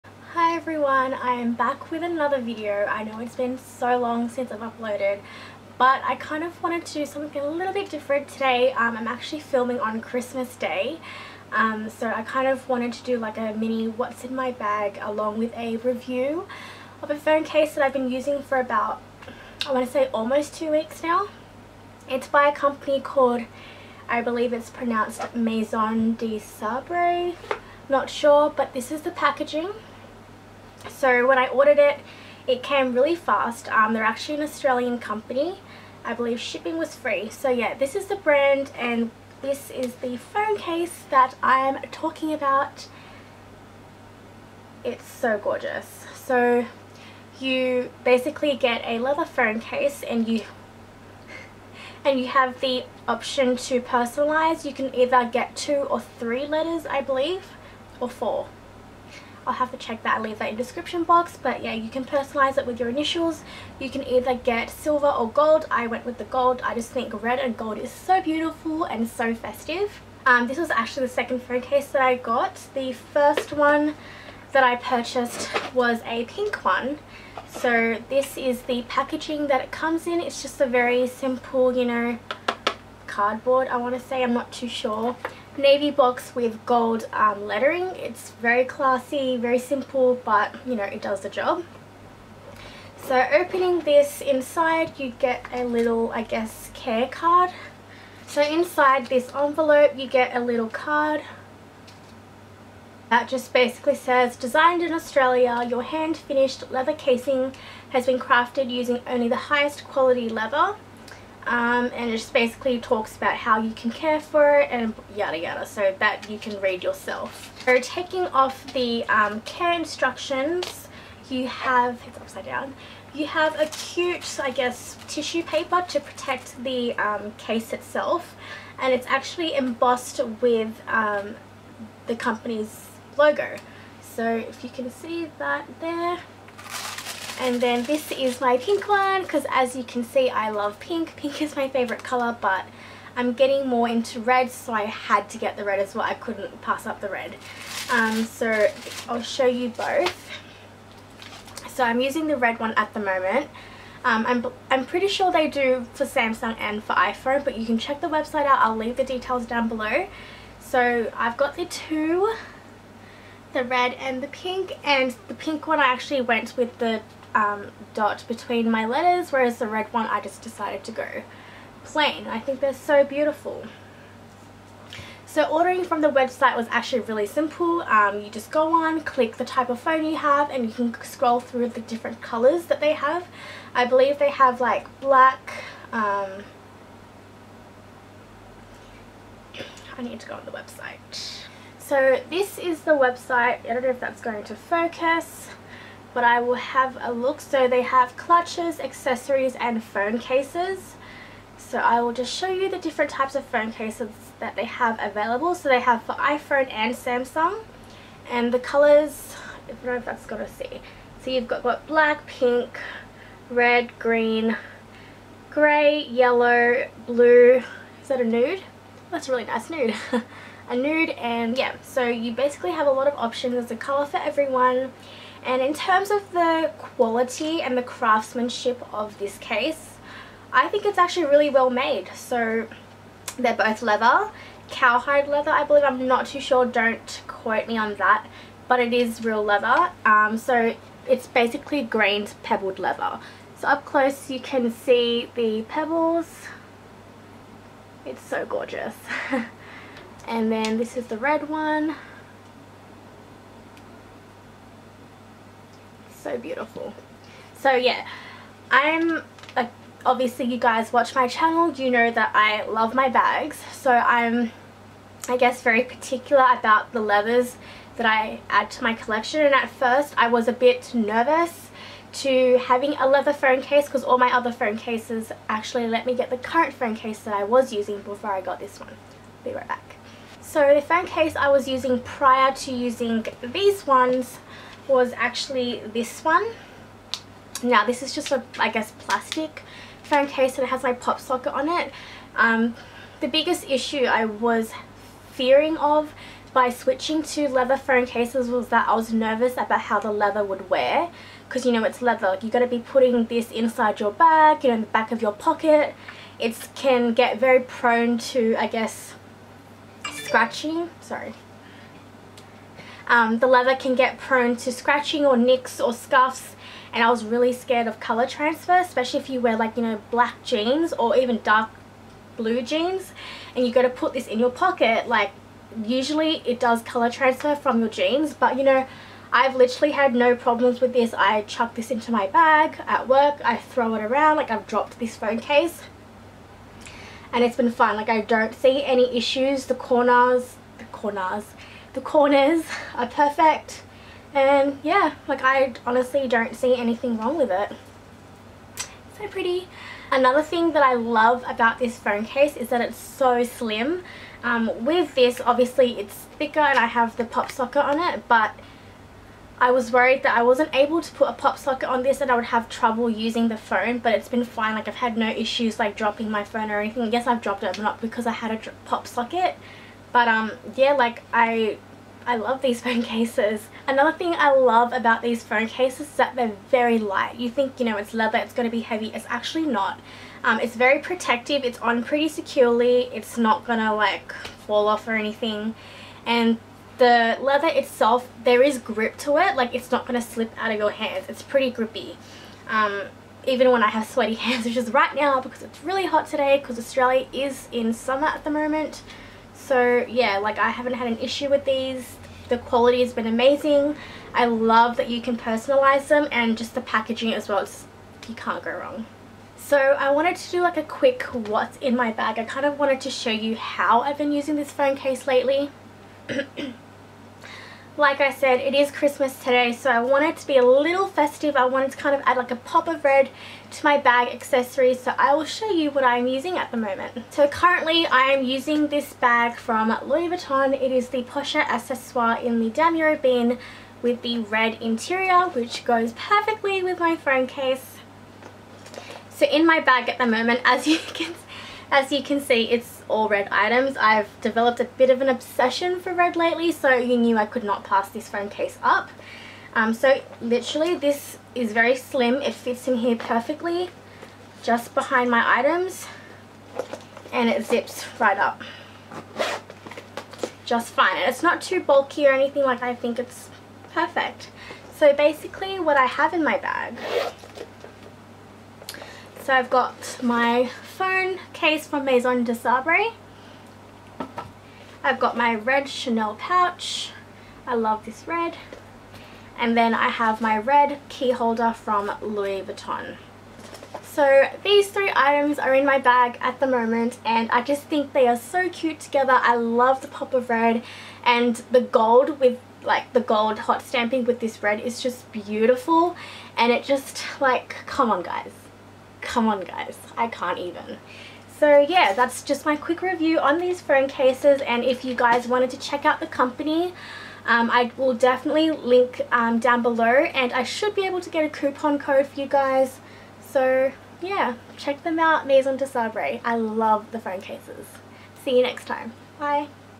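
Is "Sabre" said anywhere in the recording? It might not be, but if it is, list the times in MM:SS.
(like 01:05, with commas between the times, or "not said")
00:26, 07:52, 08:35.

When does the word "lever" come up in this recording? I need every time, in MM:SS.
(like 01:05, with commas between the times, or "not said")
not said.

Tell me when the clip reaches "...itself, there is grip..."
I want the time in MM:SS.
06:27.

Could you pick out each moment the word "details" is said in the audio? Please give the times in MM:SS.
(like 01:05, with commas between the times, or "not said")
02:39.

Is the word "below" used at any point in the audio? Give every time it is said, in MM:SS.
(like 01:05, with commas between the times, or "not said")
02:39, 08:29.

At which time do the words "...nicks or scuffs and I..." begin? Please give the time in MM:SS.
05:15.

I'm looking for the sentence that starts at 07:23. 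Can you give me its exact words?
I've developed a bit of an obsession for red lately, so you knew I could not pass this phone case up.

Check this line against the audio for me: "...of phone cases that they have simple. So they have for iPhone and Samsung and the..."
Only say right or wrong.
wrong.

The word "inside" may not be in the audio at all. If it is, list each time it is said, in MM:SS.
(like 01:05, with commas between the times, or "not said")
01:34, 01:38, 05:03.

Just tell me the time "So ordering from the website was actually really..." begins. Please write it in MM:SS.
02:55.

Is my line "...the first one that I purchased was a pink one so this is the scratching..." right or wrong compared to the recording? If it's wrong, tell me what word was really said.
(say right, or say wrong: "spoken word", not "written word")
wrong: "packaging", not "scratching".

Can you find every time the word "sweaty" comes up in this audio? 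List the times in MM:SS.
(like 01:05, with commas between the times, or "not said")
06:34.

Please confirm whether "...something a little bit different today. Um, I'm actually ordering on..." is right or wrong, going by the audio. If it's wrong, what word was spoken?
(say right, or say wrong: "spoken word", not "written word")
wrong: "filming", not "ordering".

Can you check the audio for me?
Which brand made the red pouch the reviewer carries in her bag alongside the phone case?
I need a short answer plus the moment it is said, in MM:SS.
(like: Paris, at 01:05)
Chanel, at 07:55.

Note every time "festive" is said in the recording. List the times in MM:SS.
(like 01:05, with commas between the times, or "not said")
01:09, 07:01.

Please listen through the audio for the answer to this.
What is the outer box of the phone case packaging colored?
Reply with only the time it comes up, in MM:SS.
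01:25.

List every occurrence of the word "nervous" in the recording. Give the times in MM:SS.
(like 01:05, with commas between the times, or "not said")
04:30, 04:59.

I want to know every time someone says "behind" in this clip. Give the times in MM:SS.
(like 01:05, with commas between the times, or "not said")
07:34.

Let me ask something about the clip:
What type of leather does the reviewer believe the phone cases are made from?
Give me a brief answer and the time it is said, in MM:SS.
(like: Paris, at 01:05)
Cowhide leather, at 03:54.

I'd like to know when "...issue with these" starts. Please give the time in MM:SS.
06:41.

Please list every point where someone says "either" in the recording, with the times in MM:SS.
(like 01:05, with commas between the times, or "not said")
00:54, 01:04.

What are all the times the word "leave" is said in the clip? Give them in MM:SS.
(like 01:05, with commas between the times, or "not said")
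01:00, 02:38.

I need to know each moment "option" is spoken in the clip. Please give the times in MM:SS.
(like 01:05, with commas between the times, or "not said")
00:53, 03:43.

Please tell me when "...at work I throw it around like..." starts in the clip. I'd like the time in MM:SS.
05:32.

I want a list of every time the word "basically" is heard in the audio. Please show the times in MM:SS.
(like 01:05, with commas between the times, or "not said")
00:48, 01:43, 01:52, 03:42, 04:01, 07:45.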